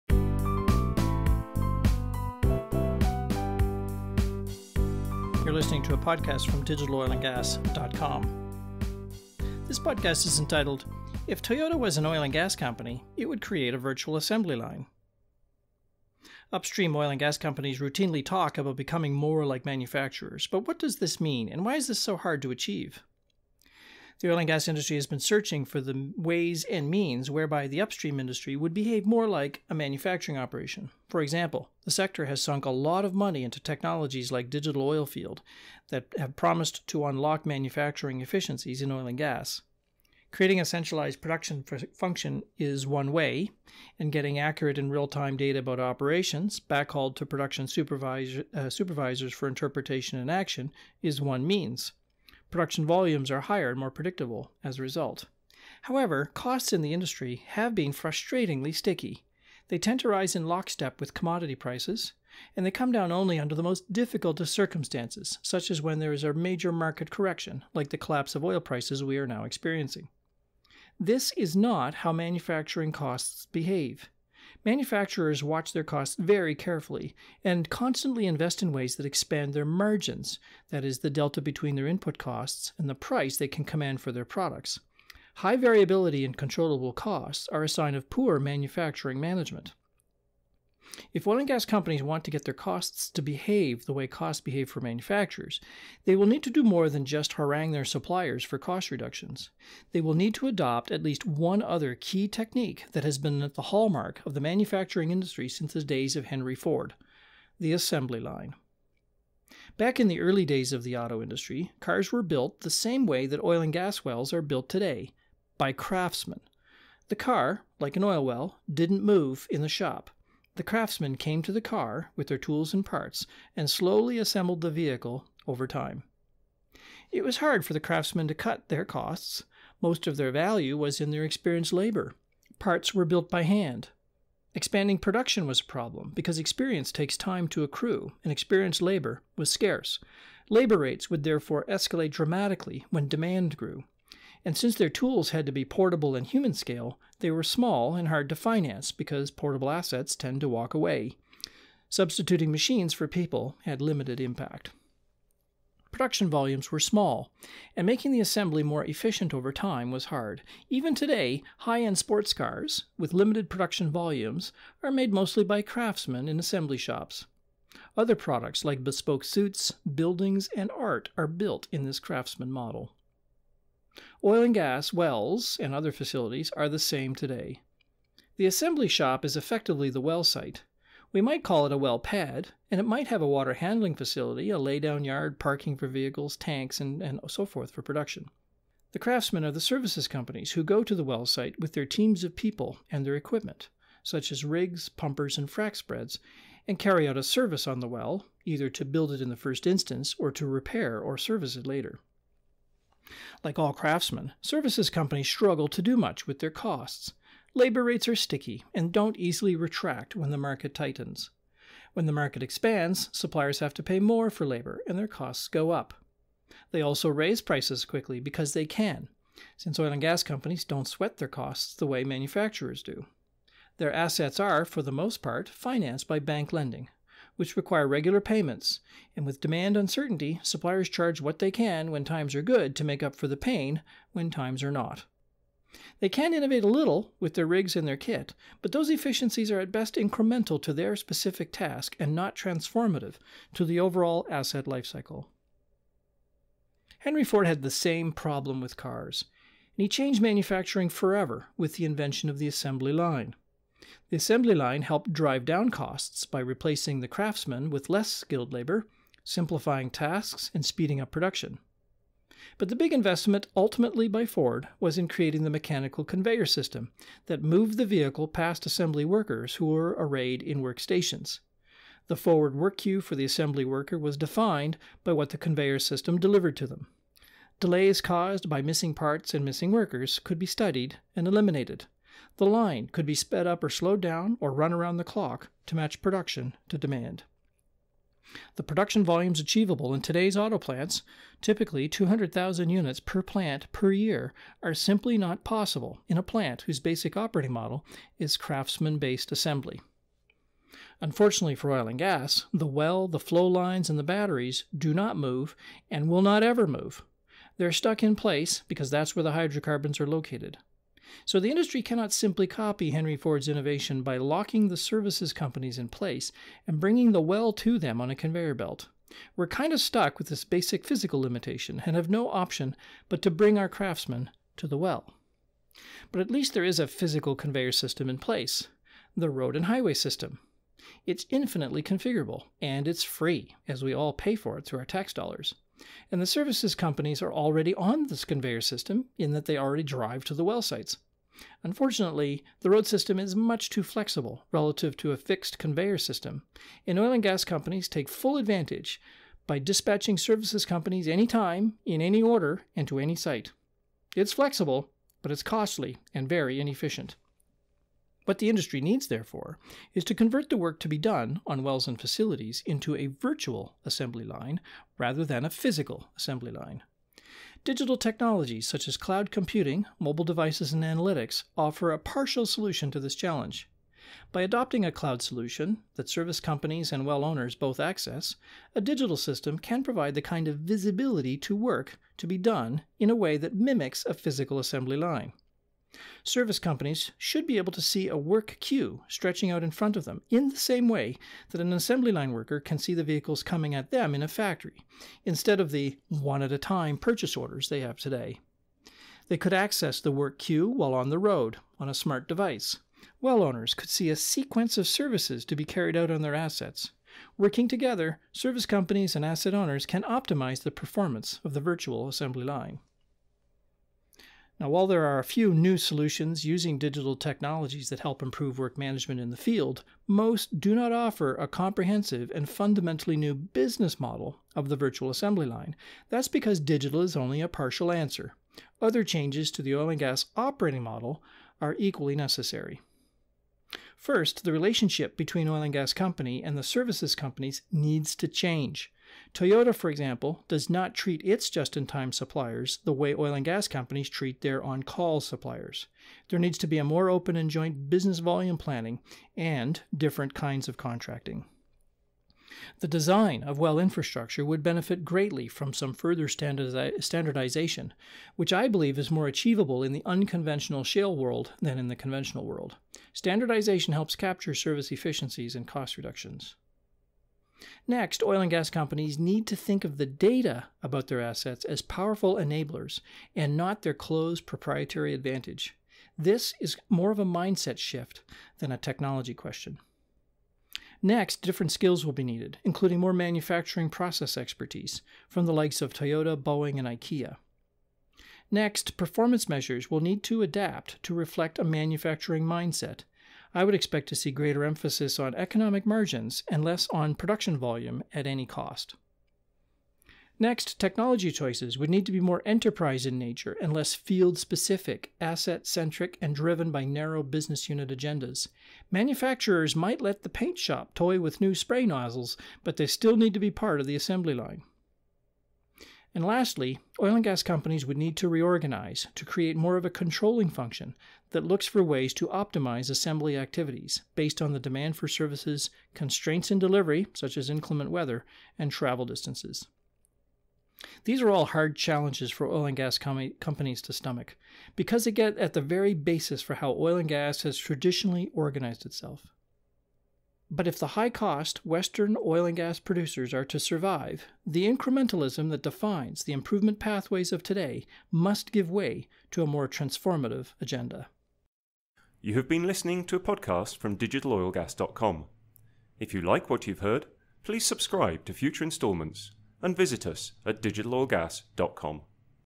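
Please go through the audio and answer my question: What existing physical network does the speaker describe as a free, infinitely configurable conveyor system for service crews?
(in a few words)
the road and highway system.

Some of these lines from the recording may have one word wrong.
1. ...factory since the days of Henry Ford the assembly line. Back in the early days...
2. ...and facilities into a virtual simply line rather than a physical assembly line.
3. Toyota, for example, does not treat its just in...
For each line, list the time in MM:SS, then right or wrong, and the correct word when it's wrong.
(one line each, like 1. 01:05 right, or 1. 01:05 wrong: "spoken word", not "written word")
1. 01:45 wrong: "industry", not "factory"
2. 06:01 wrong: "assembly", not "simply"
3. 07:19 right.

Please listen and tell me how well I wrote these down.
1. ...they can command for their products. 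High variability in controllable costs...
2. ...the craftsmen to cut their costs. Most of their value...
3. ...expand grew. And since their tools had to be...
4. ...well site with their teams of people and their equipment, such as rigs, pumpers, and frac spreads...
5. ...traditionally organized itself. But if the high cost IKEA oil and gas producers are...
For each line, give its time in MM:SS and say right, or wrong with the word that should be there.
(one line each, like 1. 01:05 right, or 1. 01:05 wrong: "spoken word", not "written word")
1. 01:23 right
2. 02:07 right
3. 02:23 wrong: "demand", not "expand"
4. 03:11 right
5. 08:57 wrong: "Western", not "IKEA".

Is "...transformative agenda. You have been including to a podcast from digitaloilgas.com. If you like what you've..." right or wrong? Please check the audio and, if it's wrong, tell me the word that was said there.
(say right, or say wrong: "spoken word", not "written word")
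wrong: "listening", not "including".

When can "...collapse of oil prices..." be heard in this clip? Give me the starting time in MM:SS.
01:07.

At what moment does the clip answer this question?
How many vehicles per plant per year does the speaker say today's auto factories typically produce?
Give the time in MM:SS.
04:51.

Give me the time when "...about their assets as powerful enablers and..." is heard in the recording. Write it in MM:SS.
07:50.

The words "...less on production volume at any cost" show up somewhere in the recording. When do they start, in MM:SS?
08:16.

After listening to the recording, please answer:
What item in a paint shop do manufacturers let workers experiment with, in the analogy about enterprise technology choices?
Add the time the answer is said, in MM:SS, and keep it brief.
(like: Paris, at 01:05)
spray nozzles, at 08:31.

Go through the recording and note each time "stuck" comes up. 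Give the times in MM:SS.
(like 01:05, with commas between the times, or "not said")
05:07, 05:19.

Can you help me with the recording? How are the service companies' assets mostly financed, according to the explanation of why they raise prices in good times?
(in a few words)
bank lending.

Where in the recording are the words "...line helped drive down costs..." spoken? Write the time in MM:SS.
04:14.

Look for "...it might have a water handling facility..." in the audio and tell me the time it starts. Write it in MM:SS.
03:02.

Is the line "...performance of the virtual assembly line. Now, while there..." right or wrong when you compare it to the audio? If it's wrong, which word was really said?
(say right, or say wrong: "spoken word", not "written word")
right.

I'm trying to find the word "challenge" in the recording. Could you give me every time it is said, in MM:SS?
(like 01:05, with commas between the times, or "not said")
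06:13, 08:51.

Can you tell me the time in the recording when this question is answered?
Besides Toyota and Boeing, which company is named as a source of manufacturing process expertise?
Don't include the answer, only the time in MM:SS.
08:06.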